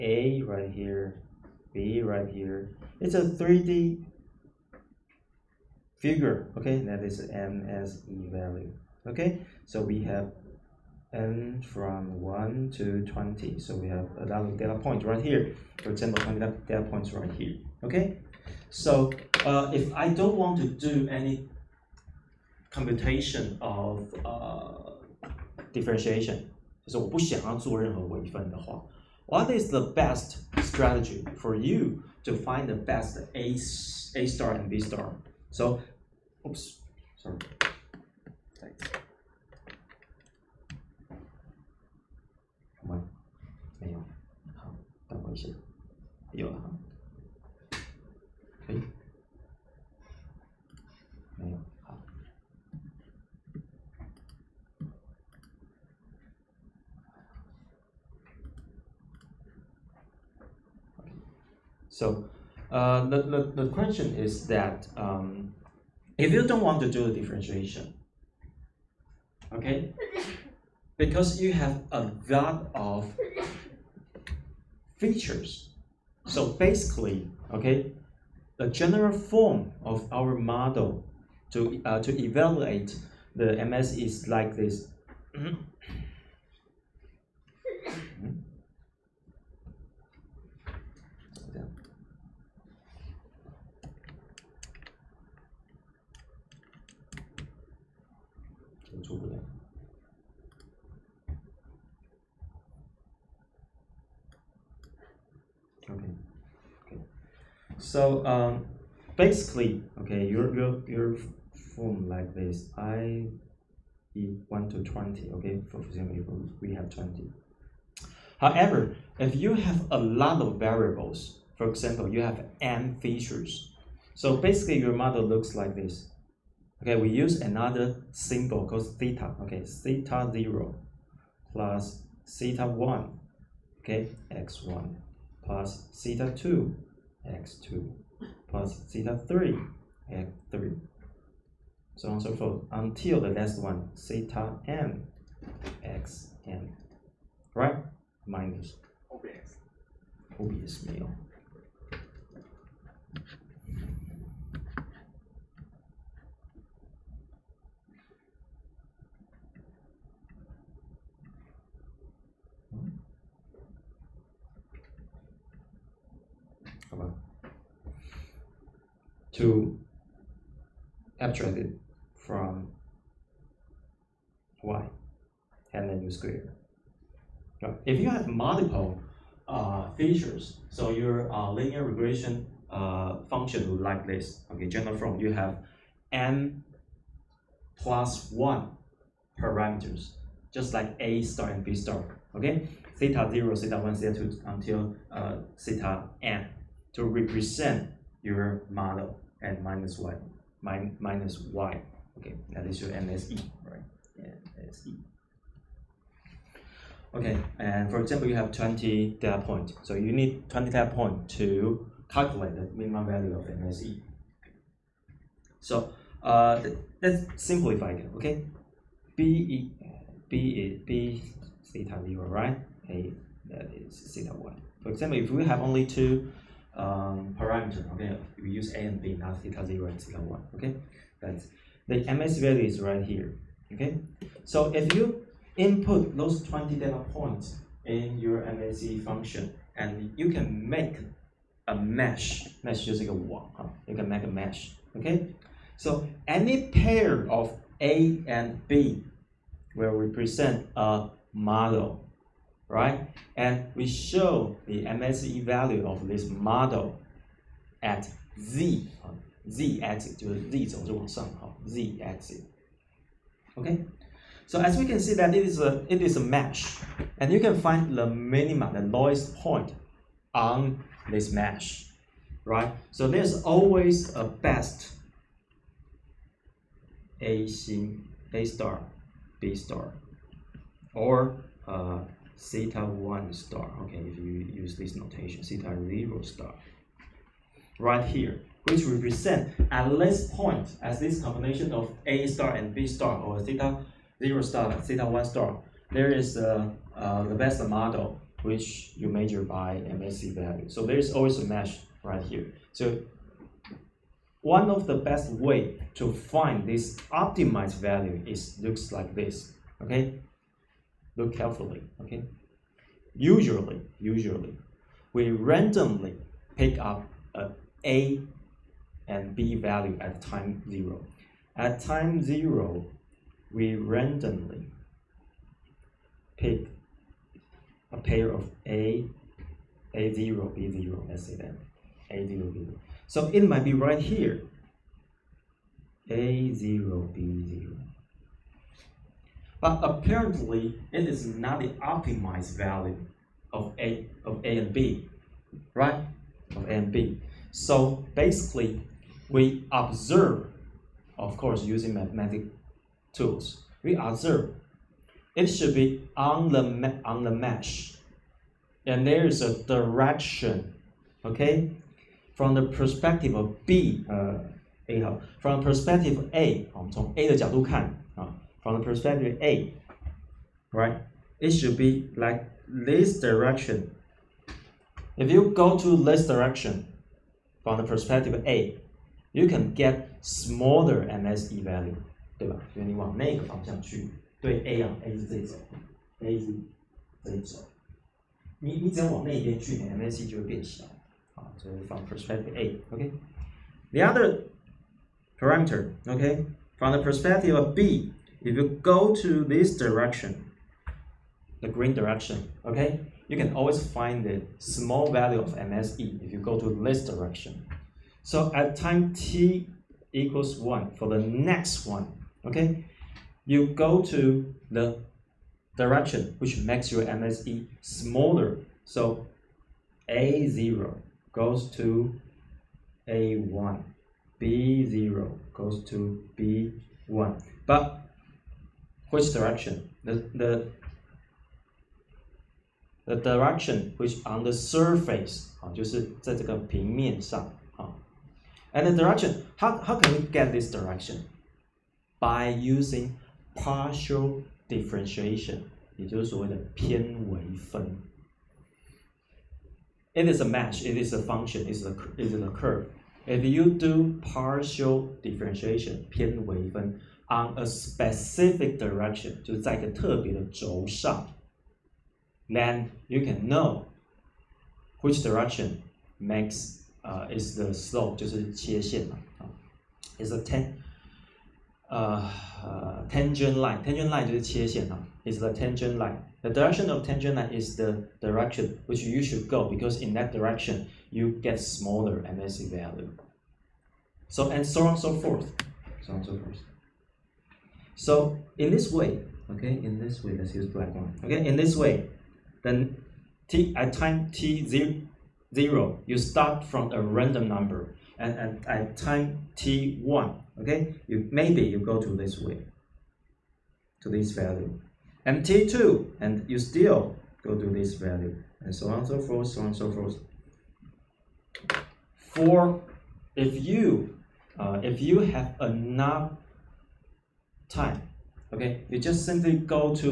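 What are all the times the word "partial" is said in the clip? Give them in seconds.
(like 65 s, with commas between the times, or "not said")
443 s, 454 s.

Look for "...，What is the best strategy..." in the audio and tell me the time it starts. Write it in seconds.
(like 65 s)
29 s.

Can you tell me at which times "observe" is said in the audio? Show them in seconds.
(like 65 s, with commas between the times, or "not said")
349 s, 353 s.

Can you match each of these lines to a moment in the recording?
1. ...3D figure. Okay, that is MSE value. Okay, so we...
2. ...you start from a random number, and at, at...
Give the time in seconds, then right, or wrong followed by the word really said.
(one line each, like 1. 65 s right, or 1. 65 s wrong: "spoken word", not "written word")
1. 3 s right
2. 496 s right.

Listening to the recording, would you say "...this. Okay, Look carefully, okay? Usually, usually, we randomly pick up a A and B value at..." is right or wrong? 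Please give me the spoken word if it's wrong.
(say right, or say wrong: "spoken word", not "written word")
right.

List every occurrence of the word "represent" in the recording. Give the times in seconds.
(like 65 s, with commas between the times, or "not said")
197 s, 249 s, 288 s.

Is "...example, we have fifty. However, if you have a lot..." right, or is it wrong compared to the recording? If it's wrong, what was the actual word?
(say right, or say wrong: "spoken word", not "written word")
wrong: "twenty", not "fifty".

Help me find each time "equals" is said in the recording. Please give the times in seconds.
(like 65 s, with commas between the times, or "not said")
410 s.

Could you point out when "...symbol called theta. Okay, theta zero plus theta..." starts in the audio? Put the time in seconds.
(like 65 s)
128 s.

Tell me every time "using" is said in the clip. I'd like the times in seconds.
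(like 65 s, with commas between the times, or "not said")
351 s, 442 s.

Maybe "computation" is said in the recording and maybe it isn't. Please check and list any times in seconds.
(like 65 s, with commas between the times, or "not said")
22 s.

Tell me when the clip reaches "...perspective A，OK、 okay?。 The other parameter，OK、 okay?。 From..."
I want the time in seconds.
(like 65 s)
392 s.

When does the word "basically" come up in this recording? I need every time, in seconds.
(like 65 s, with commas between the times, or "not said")
76 s, 109 s, 124 s, 348 s.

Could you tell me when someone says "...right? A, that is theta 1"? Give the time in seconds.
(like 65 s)
222 s.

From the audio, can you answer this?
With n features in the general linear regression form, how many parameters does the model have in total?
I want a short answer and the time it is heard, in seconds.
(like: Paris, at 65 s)
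n plus 1, at 186 s.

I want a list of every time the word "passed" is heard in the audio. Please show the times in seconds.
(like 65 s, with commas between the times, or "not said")
not said.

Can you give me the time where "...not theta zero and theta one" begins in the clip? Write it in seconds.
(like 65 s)
229 s.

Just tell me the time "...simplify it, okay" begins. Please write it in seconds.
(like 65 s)
217 s.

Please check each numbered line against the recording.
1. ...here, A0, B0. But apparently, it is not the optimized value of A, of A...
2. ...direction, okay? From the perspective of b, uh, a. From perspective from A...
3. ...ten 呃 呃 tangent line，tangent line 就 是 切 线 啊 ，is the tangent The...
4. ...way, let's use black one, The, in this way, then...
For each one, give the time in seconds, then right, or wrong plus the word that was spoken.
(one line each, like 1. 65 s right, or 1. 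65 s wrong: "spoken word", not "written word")
1. 334 s right
2. 359 s right
3. 470 s right
4. 490 s wrong: "Okay", not "The".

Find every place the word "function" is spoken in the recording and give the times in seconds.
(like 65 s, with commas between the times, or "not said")
183 s, 239 s, 451 s.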